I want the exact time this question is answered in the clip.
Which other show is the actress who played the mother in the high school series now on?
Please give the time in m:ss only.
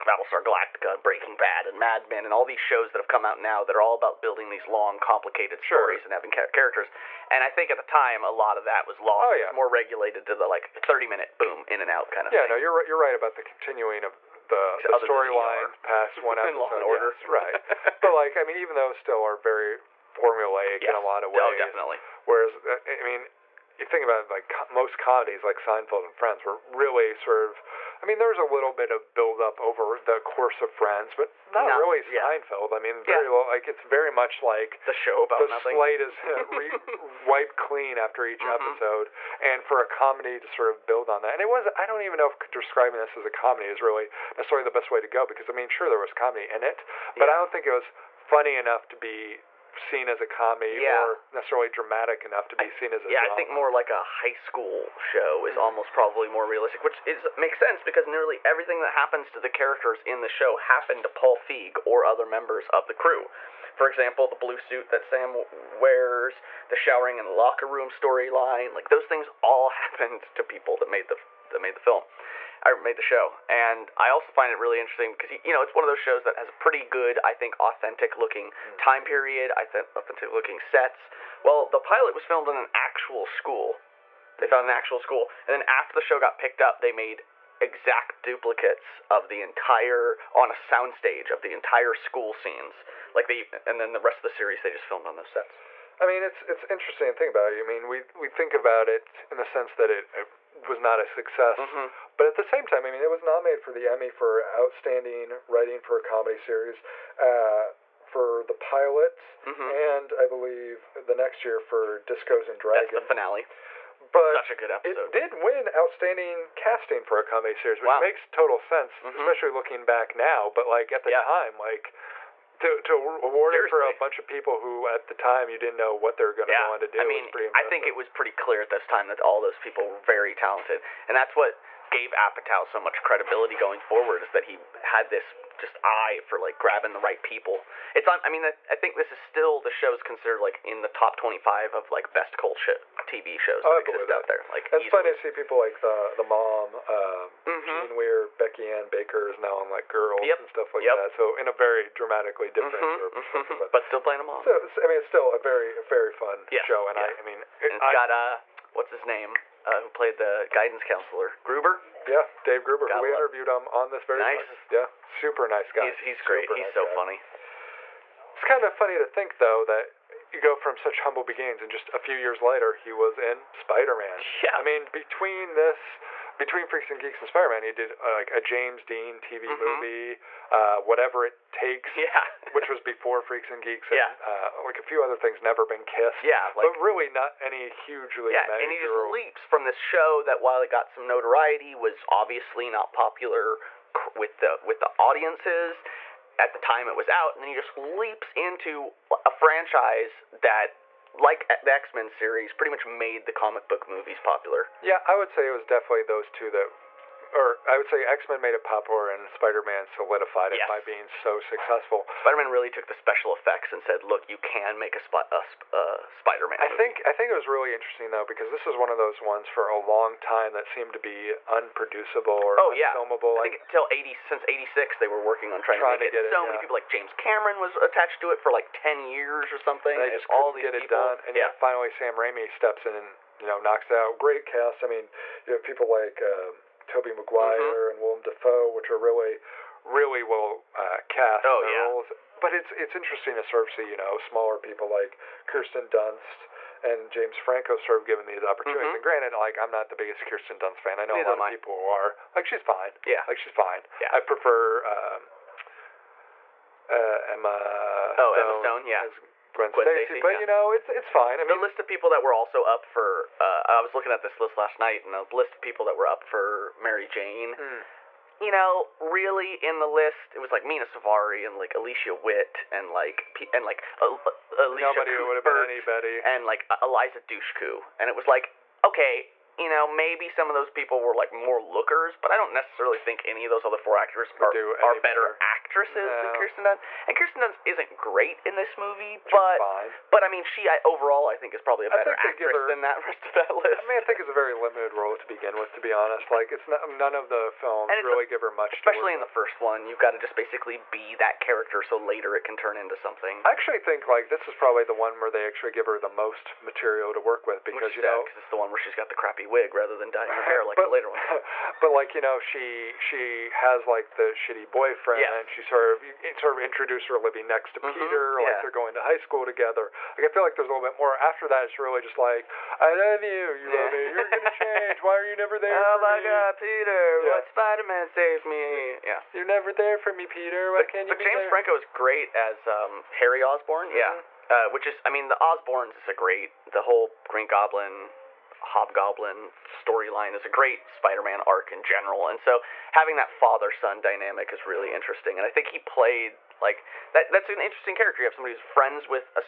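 2:29.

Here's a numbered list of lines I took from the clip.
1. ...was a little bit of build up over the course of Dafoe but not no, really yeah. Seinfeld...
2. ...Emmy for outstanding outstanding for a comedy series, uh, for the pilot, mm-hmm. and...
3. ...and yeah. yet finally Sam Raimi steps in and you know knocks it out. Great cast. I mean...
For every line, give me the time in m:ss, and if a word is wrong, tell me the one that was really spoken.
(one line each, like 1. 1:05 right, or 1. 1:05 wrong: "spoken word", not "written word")
1. 0:28 wrong: "Friends", not "Dafoe"
2. 1:43 wrong: "writing", not "outstanding"
3. 3:51 right.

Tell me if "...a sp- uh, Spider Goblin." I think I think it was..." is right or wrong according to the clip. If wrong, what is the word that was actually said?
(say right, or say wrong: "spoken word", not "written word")
wrong: "Man", not "Goblin".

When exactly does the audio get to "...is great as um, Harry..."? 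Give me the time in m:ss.
5:31.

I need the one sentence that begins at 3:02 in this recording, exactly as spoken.
which was before Freaks and Geeks, and yeah.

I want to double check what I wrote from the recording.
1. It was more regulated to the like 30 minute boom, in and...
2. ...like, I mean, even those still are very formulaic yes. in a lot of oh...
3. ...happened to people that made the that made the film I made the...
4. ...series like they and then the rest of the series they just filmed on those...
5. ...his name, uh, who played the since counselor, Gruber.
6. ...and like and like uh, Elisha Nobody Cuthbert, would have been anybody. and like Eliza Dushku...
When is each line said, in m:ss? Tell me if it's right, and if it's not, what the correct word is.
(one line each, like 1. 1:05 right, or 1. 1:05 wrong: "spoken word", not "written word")
1. 0:09 right
2. 0:18 right
3. 1:09 right
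4. 1:32 wrong: "scenes", not "series"
5. 2:38 wrong: "guidance", not "since"
6. 4:32 right.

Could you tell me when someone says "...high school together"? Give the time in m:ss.
5:19.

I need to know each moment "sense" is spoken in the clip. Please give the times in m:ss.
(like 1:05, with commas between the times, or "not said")
0:57, 1:39, 1:58.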